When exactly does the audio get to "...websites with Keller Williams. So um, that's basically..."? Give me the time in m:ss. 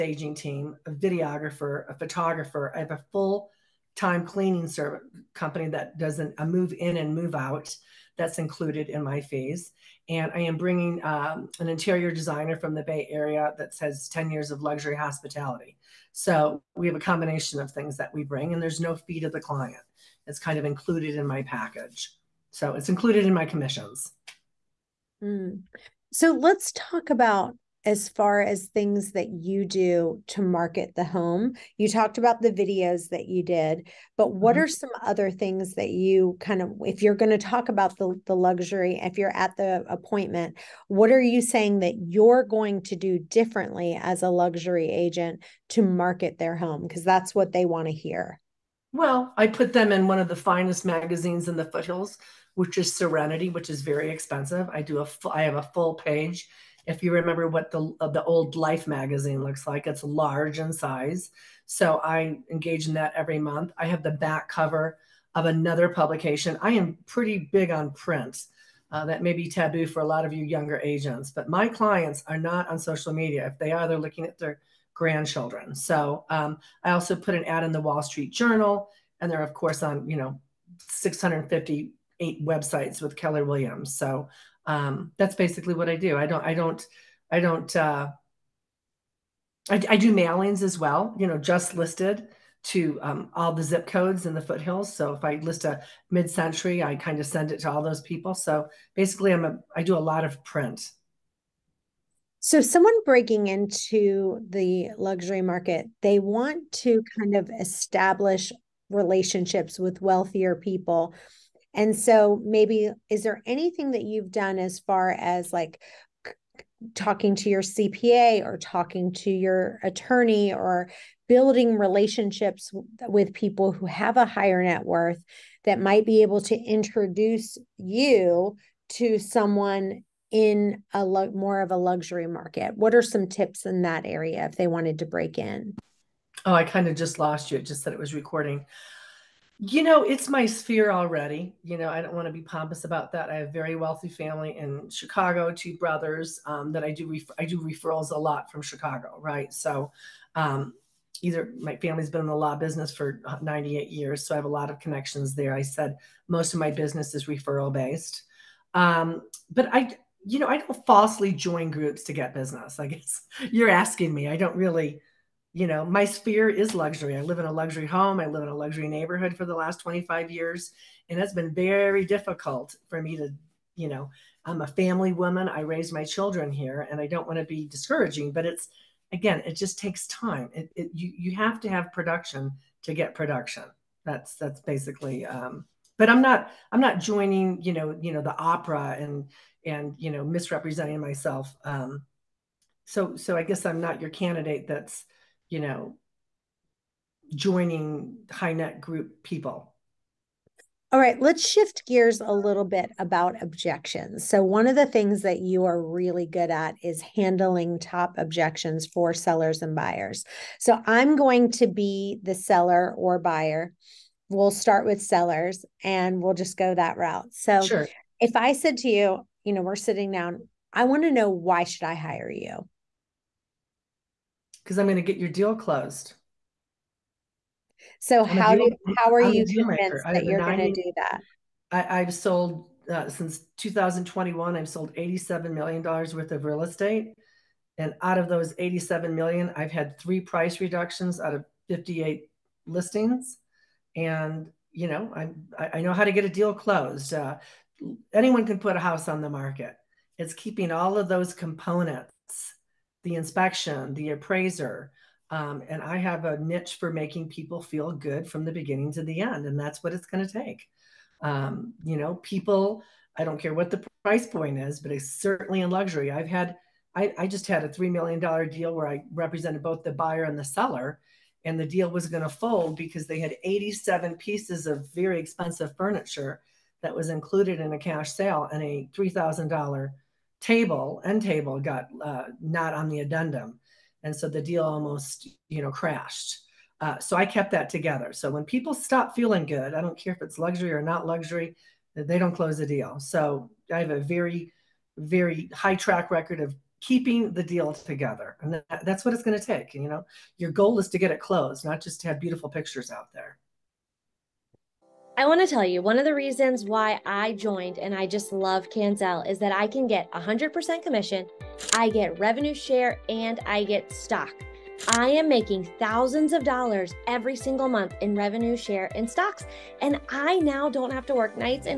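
1:22.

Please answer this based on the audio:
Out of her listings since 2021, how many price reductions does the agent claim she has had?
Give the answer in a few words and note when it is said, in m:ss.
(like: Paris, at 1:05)
3, at 3:59.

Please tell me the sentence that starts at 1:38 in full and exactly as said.
So basically, I'm a I do a lot of print.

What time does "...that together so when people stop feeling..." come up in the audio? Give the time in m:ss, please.
4:47.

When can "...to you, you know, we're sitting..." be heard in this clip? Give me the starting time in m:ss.
3:38.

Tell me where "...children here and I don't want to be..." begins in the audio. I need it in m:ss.
2:56.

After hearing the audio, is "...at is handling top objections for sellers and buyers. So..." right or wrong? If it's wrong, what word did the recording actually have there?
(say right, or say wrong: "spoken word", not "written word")
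right.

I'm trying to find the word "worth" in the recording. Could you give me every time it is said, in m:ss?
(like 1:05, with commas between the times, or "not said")
2:04, 3:56.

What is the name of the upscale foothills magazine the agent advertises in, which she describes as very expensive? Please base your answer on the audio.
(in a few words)
Serenity.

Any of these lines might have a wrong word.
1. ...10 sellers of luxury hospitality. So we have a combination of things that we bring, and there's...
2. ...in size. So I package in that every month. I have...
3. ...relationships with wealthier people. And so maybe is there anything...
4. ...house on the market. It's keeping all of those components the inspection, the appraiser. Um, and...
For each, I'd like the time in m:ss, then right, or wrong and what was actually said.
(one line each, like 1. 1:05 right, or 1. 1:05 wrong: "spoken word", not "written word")
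1. 0:14 wrong: "years", not "sellers"
2. 1:00 wrong: "engage", not "package"
3. 1:48 right
4. 4:08 right.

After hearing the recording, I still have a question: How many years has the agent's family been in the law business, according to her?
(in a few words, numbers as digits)
98.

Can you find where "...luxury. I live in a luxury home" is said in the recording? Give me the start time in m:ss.
2:46.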